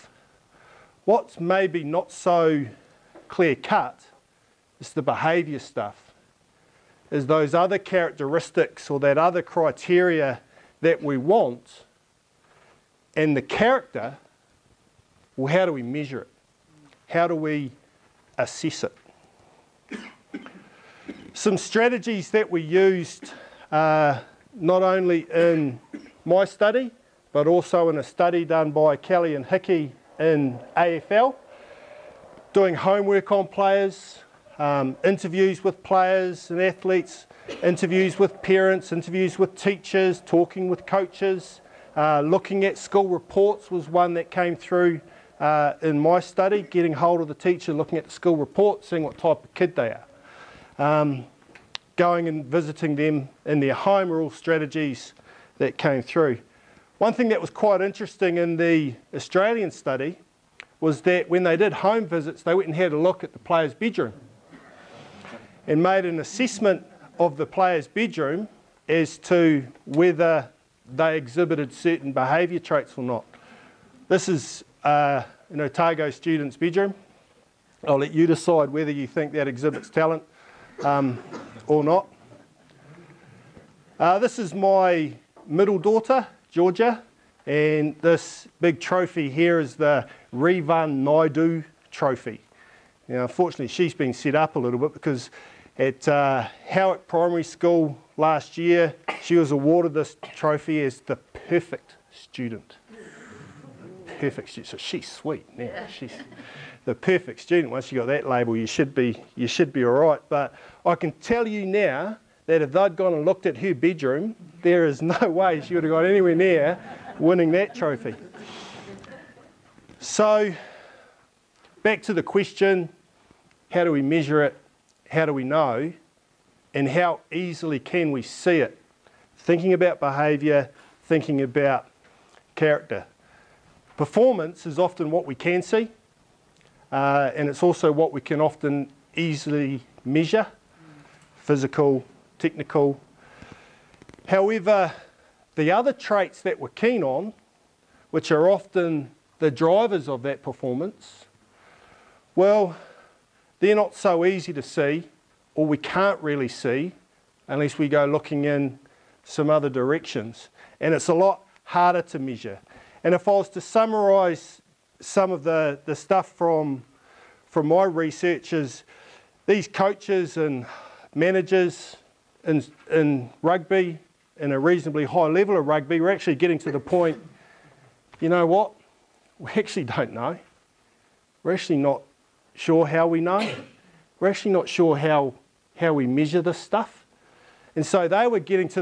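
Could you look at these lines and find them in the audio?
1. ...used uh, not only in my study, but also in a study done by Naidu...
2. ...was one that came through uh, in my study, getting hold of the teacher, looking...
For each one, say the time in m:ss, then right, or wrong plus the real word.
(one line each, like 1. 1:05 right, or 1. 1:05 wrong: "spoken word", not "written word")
1. 0:22 wrong: "Kelly", not "Naidu"
2. 0:43 right.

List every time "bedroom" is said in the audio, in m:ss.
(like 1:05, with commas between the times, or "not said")
1:03, 1:07, 1:16, 1:53.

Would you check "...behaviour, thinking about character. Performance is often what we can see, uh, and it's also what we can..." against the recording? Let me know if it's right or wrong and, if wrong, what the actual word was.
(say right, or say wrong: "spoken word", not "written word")
right.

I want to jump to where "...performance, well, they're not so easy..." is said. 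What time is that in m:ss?
2:30.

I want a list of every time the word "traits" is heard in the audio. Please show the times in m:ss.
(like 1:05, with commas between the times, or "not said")
1:12, 2:25.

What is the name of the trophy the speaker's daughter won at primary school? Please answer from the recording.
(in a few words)
Revan Naidu trophy.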